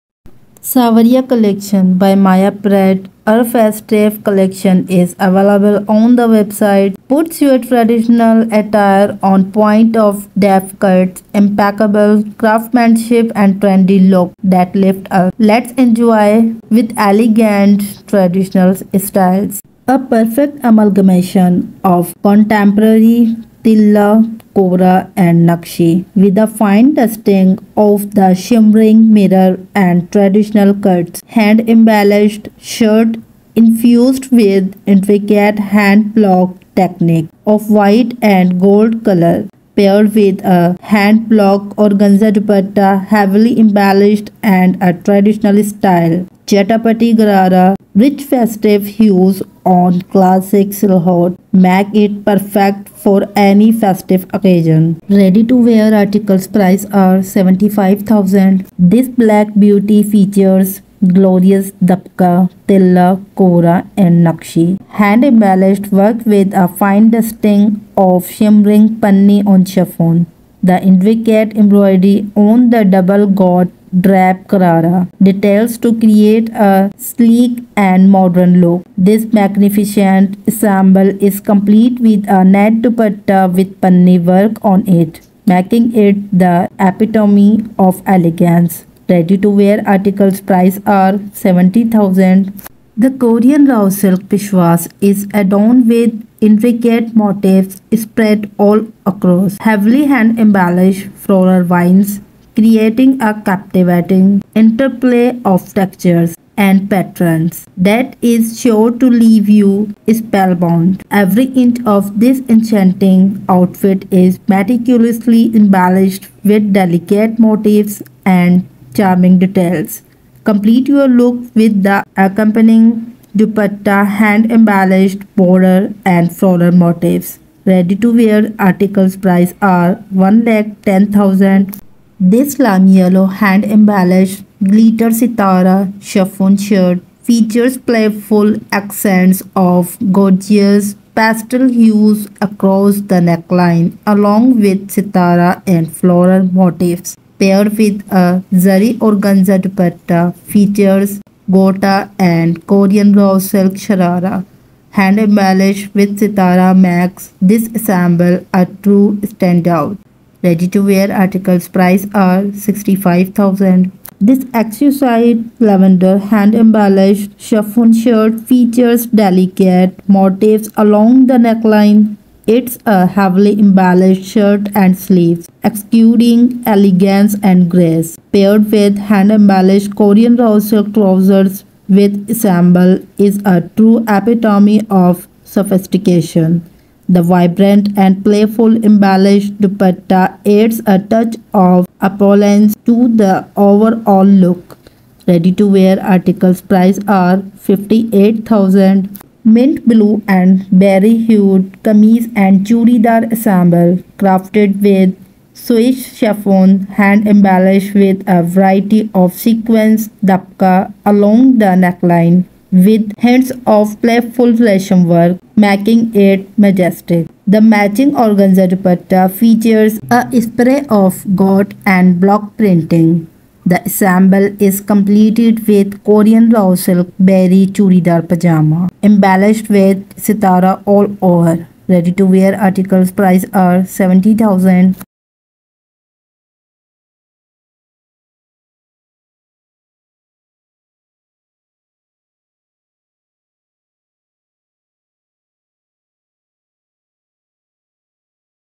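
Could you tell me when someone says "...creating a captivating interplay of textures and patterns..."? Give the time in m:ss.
1:42.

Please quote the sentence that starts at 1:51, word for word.
Every inch of this enchanting outfit is meticulously embellished with delicate motifs and charming details.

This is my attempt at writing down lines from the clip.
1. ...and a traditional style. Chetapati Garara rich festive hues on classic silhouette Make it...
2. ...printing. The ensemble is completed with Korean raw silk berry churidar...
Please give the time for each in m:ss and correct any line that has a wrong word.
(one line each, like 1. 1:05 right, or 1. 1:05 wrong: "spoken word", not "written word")
1. 0:44 right
2. 3:42 right.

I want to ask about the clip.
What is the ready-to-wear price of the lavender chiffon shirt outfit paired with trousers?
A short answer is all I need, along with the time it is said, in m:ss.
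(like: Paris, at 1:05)
58,000, at 3:17.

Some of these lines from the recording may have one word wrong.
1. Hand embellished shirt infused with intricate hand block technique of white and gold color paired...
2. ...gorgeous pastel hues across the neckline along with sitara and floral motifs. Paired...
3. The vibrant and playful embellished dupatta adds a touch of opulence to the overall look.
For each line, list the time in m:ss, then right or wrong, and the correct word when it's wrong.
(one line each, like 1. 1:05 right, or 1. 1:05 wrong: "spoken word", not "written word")
1. 0:31 right
2. 2:20 right
3. 3:07 right.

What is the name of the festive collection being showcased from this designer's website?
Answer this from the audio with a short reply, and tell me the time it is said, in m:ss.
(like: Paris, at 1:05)
Saawariya, at 0:00.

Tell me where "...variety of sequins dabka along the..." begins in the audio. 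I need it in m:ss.
3:28.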